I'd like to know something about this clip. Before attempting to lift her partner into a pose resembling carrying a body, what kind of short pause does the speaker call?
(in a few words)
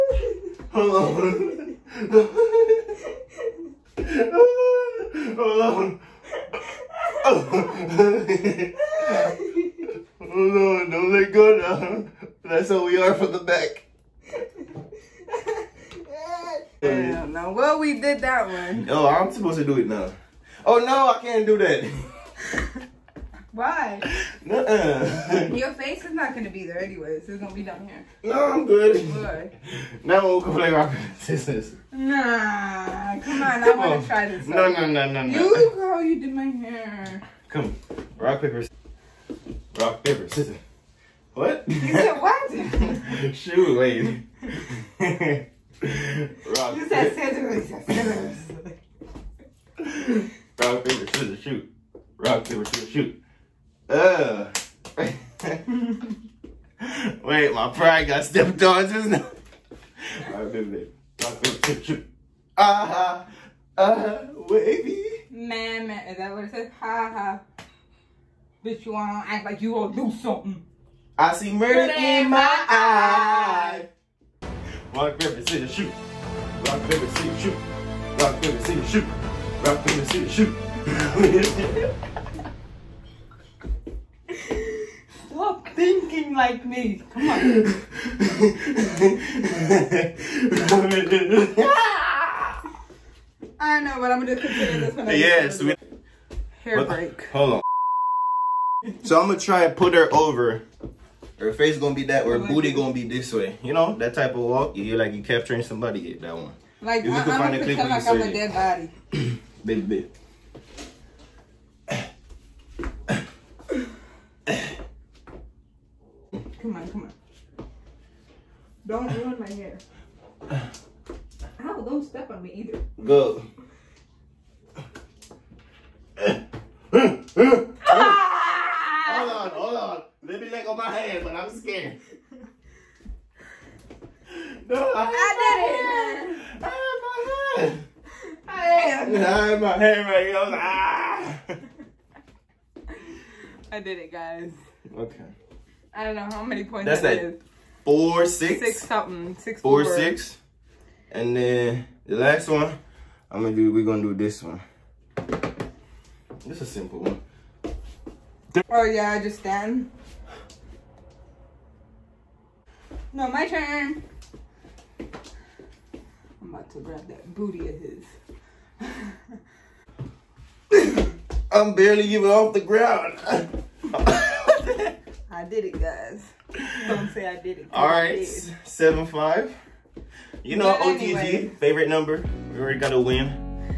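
Hair break.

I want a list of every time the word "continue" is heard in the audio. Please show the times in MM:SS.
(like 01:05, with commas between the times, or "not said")
01:34.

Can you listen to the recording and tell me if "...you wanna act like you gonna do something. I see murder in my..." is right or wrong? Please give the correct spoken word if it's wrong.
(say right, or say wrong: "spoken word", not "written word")
right.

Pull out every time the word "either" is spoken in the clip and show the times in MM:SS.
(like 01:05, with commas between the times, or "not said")
02:02.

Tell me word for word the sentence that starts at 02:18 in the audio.
I had, I had my hand right here.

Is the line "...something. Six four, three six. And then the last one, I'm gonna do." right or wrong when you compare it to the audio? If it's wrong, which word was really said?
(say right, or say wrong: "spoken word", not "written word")
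wrong: "four", not "three".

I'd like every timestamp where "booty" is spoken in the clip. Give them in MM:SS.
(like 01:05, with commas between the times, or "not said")
01:42, 02:47.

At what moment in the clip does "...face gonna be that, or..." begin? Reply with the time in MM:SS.
01:41.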